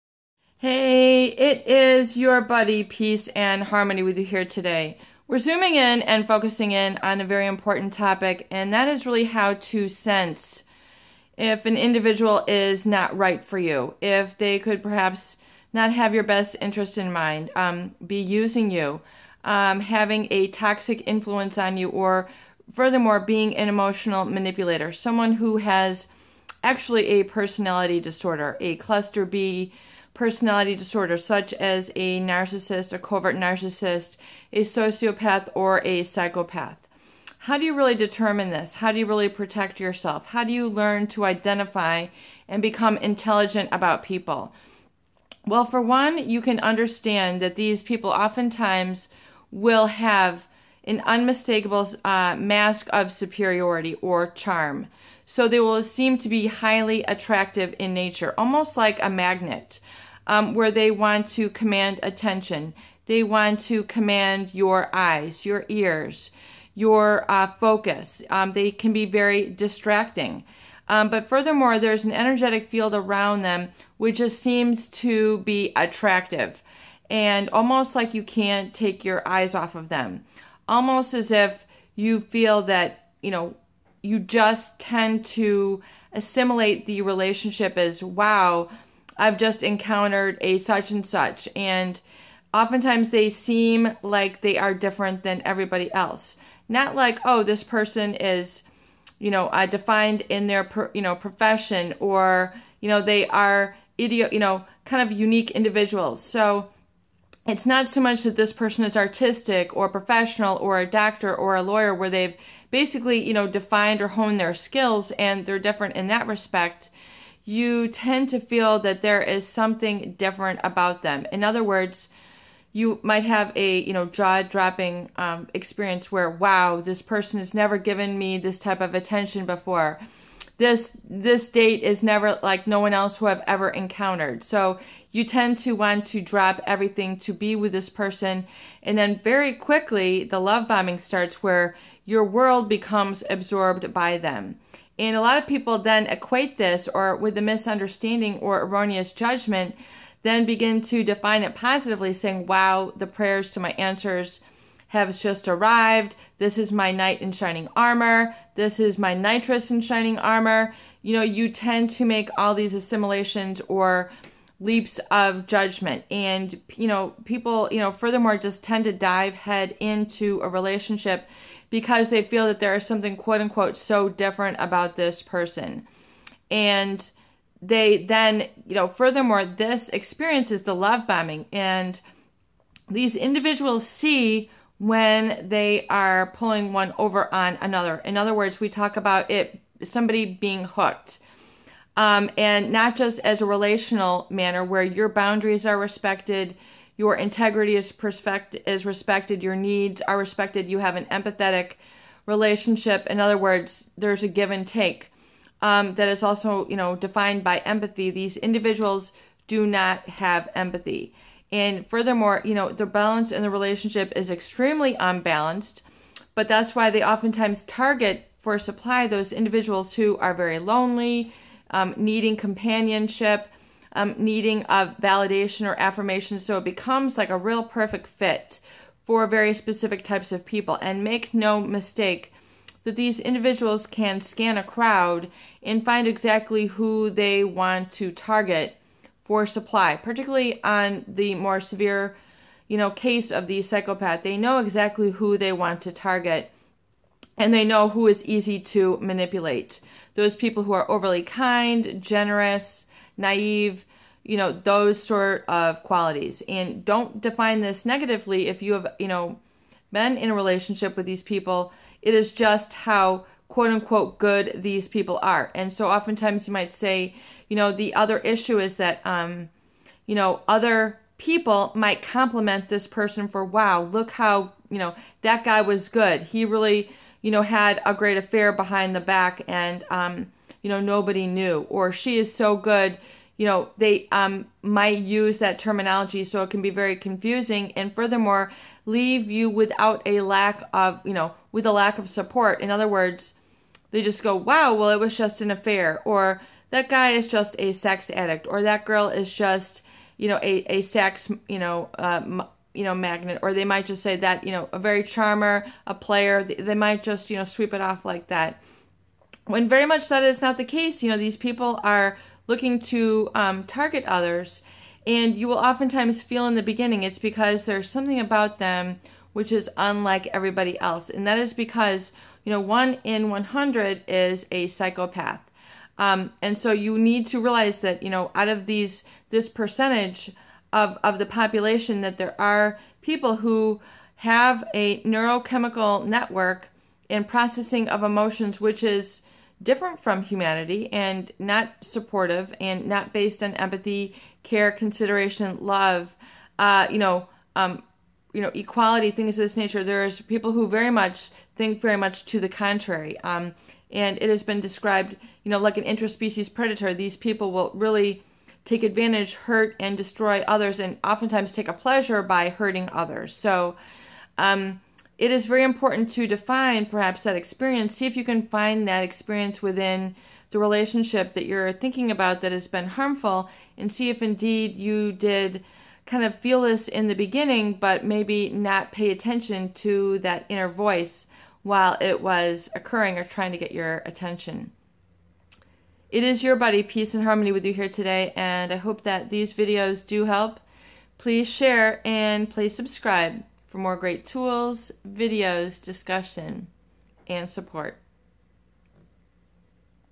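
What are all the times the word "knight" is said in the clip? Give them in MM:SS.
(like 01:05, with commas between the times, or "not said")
02:36.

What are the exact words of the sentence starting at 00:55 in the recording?
So they will seem to be highly attractive in nature, almost like a magnet um, where they want to command attention.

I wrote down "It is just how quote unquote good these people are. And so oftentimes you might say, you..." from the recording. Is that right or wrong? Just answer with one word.
right.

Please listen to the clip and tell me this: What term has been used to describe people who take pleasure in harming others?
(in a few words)
interspecies predator.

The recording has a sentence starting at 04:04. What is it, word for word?
They know exactly who they want to target and they know who is easy to manipulate.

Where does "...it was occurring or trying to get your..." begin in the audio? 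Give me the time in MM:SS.
06:22.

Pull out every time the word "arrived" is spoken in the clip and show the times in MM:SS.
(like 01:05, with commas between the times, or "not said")
02:35.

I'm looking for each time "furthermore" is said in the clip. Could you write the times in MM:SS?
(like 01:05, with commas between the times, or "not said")
00:22, 01:11, 02:47, 02:58, 03:31, 04:47.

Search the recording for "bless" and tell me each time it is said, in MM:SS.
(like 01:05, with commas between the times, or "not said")
not said.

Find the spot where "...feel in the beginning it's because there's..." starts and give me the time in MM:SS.
05:16.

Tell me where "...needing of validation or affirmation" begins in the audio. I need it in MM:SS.
03:44.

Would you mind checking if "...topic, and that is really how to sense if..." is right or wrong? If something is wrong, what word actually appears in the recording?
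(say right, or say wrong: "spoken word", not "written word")
right.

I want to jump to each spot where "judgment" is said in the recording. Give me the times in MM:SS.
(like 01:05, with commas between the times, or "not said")
02:29, 02:45.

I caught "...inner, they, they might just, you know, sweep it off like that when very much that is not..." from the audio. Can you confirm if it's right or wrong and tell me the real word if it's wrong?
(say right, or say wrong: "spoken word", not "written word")
wrong: "player", not "inner".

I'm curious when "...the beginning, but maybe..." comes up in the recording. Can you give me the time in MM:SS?
06:17.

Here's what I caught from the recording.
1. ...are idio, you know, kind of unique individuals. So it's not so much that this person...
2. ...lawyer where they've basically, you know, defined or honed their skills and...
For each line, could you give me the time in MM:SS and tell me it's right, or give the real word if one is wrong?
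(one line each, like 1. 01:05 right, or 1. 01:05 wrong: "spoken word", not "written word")
1. 01:43 right
2. 01:51 right.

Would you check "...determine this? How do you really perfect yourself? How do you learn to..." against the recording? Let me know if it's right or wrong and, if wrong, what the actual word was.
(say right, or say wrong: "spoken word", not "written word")
wrong: "protect", not "perfect".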